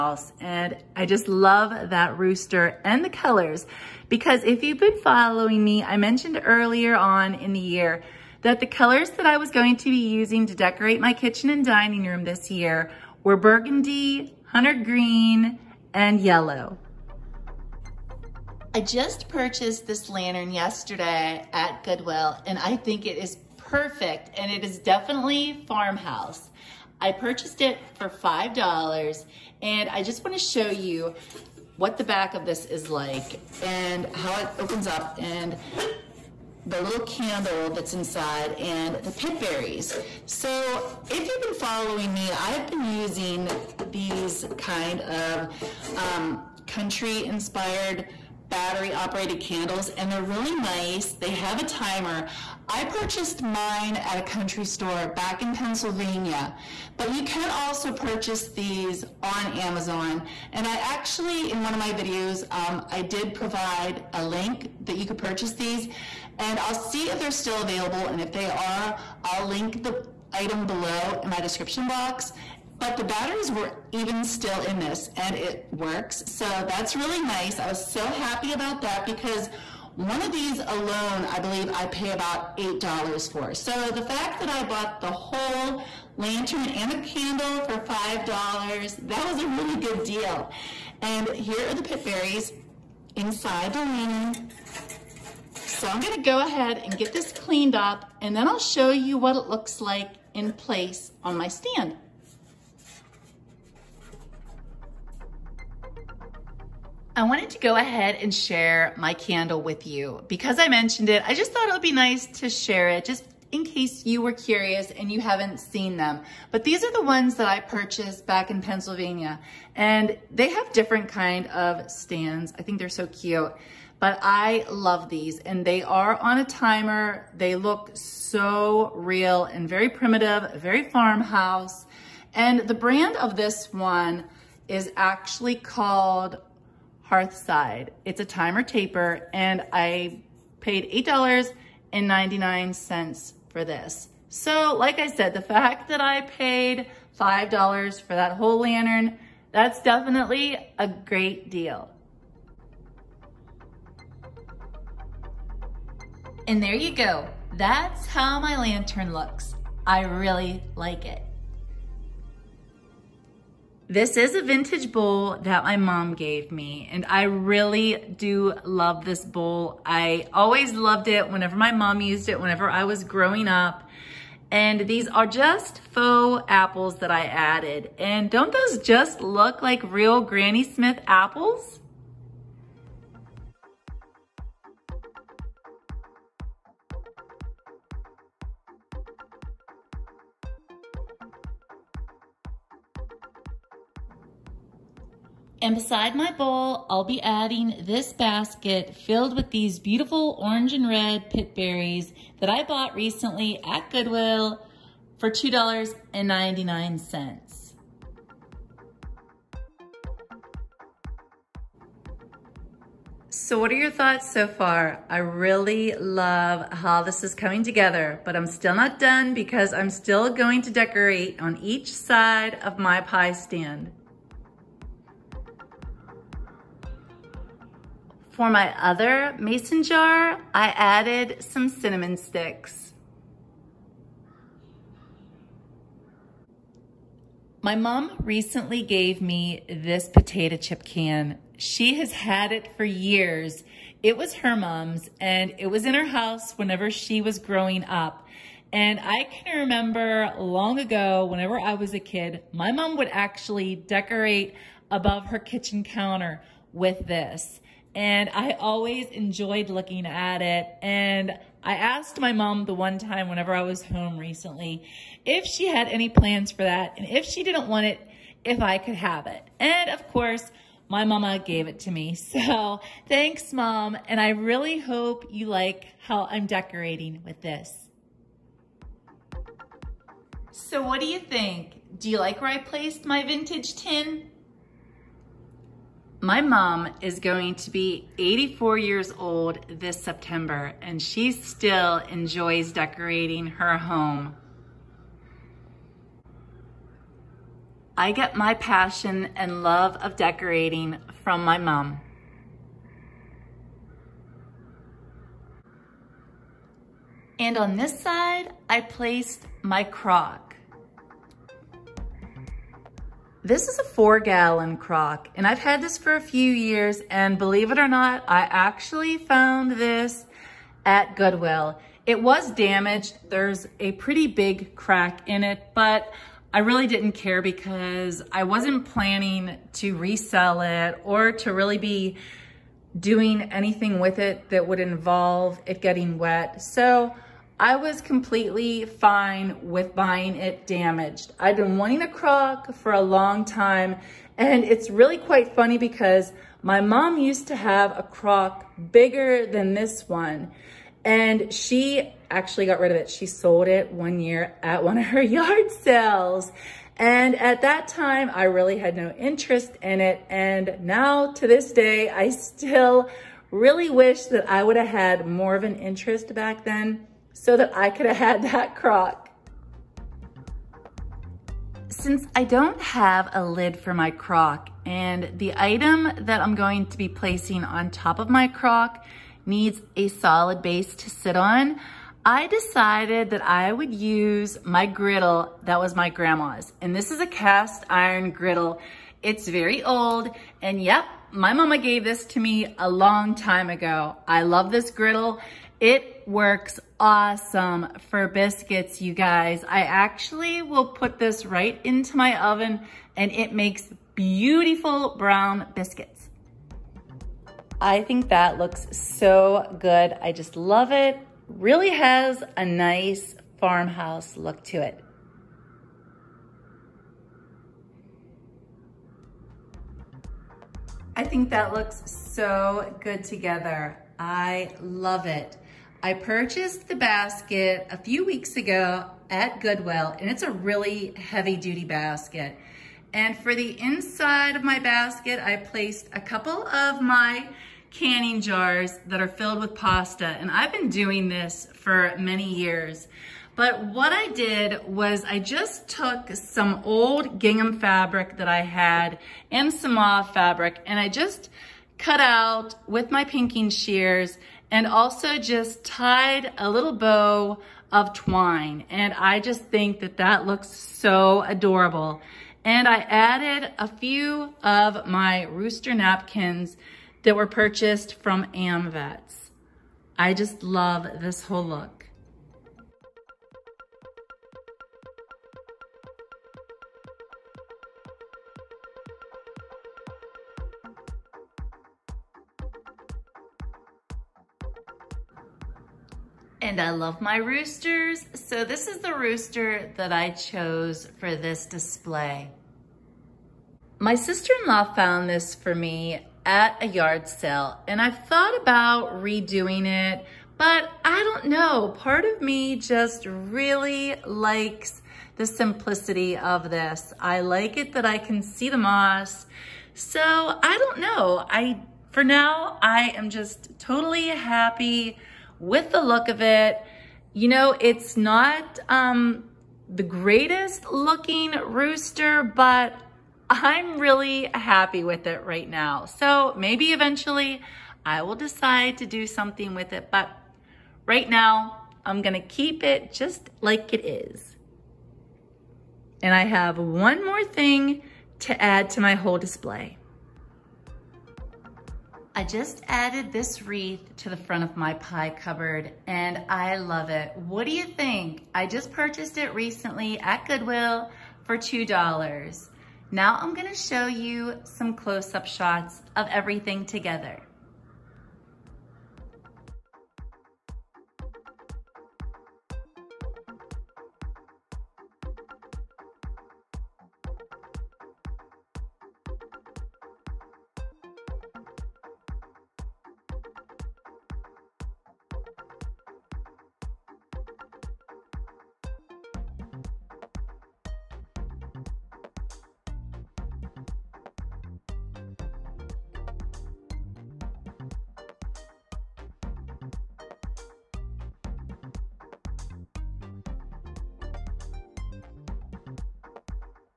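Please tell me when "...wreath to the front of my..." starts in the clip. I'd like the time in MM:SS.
09:03.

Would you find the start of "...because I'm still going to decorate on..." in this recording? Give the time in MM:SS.
03:39.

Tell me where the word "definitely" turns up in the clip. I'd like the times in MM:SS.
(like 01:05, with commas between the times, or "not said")
00:24, 02:29.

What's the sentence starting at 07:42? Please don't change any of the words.
And I added a few of my rooster napkins that were purchased from AmVets.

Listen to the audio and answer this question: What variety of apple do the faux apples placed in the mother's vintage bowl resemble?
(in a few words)
Granny Smith.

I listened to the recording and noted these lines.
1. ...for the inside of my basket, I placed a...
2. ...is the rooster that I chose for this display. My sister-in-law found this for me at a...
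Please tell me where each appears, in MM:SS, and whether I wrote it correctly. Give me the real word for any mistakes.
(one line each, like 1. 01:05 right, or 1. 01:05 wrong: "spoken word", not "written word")
1. 07:13 right
2. 08:08 right.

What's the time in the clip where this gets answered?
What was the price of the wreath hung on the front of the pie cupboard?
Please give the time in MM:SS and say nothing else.
09:11.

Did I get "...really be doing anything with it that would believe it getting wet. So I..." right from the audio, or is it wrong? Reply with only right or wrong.
wrong.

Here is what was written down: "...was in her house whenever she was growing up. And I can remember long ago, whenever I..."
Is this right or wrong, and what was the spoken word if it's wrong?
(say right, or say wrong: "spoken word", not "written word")
right.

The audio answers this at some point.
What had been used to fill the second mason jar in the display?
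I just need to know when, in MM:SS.
03:51.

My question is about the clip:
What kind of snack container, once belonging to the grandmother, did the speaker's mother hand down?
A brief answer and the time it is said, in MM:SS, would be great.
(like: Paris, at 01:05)
potato chip can, at 04:00.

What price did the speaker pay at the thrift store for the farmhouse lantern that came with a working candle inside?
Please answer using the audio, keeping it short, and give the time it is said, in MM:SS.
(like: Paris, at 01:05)
$5, at 00:27.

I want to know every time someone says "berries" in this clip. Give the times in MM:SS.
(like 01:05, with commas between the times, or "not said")
00:39, 01:32, 03:21.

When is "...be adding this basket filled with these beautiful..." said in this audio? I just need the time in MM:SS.
03:17.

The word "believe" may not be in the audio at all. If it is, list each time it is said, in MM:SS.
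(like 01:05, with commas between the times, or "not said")
01:21, 05:17.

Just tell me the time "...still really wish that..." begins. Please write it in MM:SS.
06:02.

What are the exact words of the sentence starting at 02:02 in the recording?
I think they're so cute, but I love these and they are on a timer.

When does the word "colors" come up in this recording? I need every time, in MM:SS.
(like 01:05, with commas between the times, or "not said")
00:03, 00:08.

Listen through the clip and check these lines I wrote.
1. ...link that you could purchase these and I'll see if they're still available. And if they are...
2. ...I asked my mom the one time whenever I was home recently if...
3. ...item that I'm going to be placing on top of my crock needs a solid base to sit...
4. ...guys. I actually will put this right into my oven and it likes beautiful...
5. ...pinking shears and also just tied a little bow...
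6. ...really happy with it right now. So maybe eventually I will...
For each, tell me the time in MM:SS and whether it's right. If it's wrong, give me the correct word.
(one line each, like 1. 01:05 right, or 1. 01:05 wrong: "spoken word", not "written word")
1. 01:04 right
2. 04:21 right
3. 06:15 right
4. 06:39 wrong: "makes", not "likes"
5. 07:33 right
6. 08:43 right.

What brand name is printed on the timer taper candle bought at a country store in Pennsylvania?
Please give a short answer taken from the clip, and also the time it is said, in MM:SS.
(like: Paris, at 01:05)
Hearthside, at 02:17.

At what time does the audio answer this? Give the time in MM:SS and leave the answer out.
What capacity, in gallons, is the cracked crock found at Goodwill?
05:13.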